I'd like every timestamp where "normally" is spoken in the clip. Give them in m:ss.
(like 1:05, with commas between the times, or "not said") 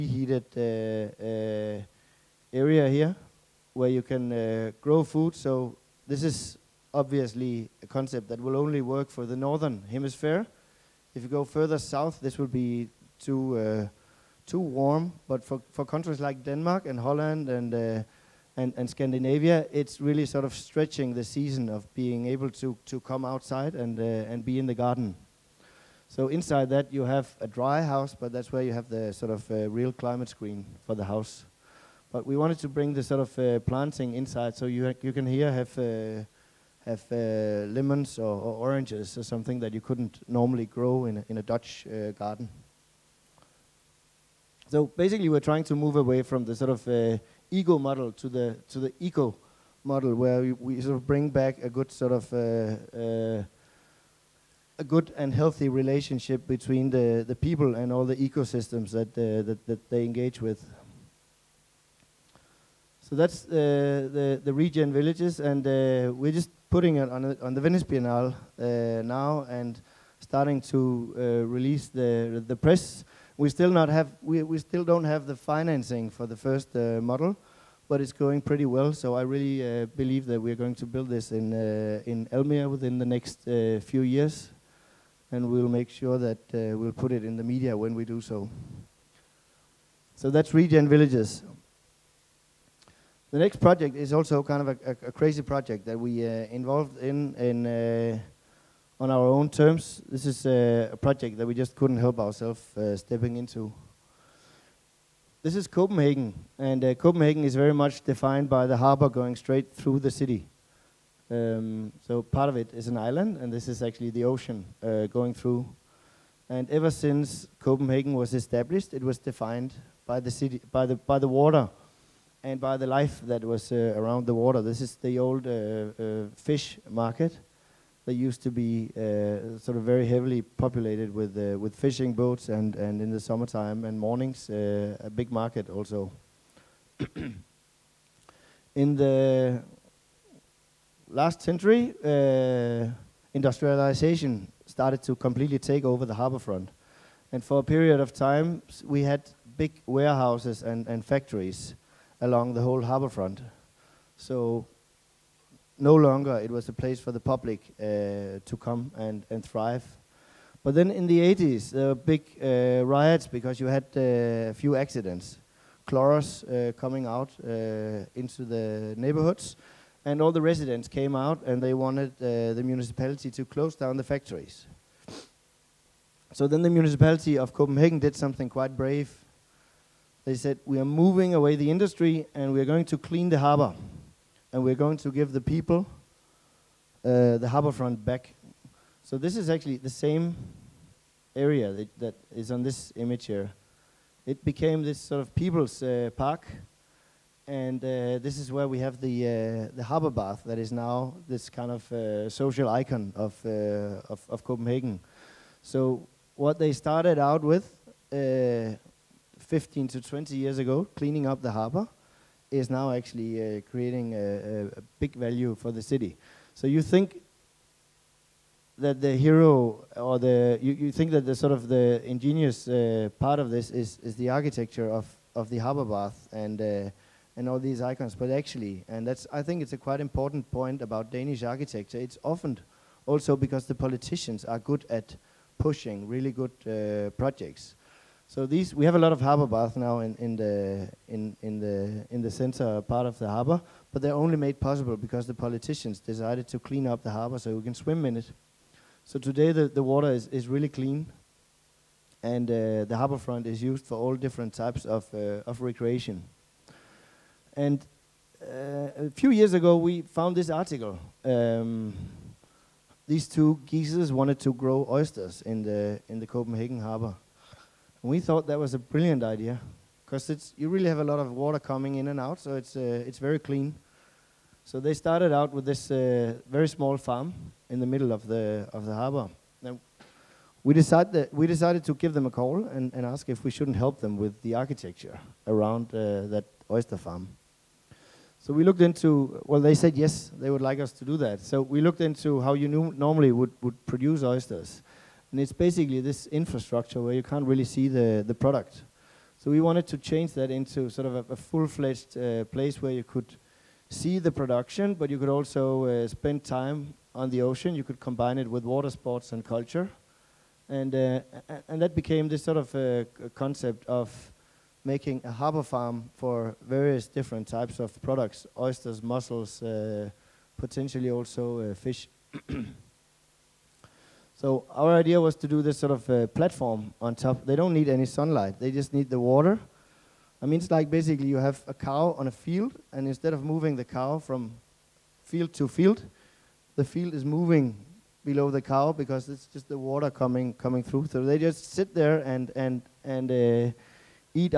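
0:40, 4:52.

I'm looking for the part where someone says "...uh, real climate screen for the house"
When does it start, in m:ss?
0:29.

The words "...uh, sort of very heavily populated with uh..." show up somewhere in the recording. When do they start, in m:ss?
2:08.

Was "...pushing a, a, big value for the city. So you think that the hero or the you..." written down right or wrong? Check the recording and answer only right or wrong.
wrong.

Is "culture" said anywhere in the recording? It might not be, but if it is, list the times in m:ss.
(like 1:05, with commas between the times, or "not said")
5:09.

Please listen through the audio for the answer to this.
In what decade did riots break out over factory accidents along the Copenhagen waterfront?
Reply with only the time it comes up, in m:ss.
2:41.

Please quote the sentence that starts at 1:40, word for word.
This is a project that we just couldn't help ourselves uh, stepping into.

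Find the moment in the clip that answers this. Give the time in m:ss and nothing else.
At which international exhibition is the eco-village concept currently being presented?
1:07.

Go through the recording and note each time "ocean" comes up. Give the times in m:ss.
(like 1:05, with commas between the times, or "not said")
1:54, 5:07.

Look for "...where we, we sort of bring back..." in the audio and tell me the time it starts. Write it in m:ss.
0:50.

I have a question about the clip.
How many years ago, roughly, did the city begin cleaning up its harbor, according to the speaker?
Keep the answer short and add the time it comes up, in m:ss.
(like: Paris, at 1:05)
15 to 20, at 3:28.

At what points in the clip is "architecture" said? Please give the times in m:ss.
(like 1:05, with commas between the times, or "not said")
3:44, 3:51, 4:44.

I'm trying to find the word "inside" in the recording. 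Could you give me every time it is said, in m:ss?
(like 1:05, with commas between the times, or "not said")
0:26, 0:34.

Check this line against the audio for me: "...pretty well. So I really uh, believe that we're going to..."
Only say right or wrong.
right.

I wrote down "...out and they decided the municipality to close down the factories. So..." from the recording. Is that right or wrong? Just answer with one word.
wrong.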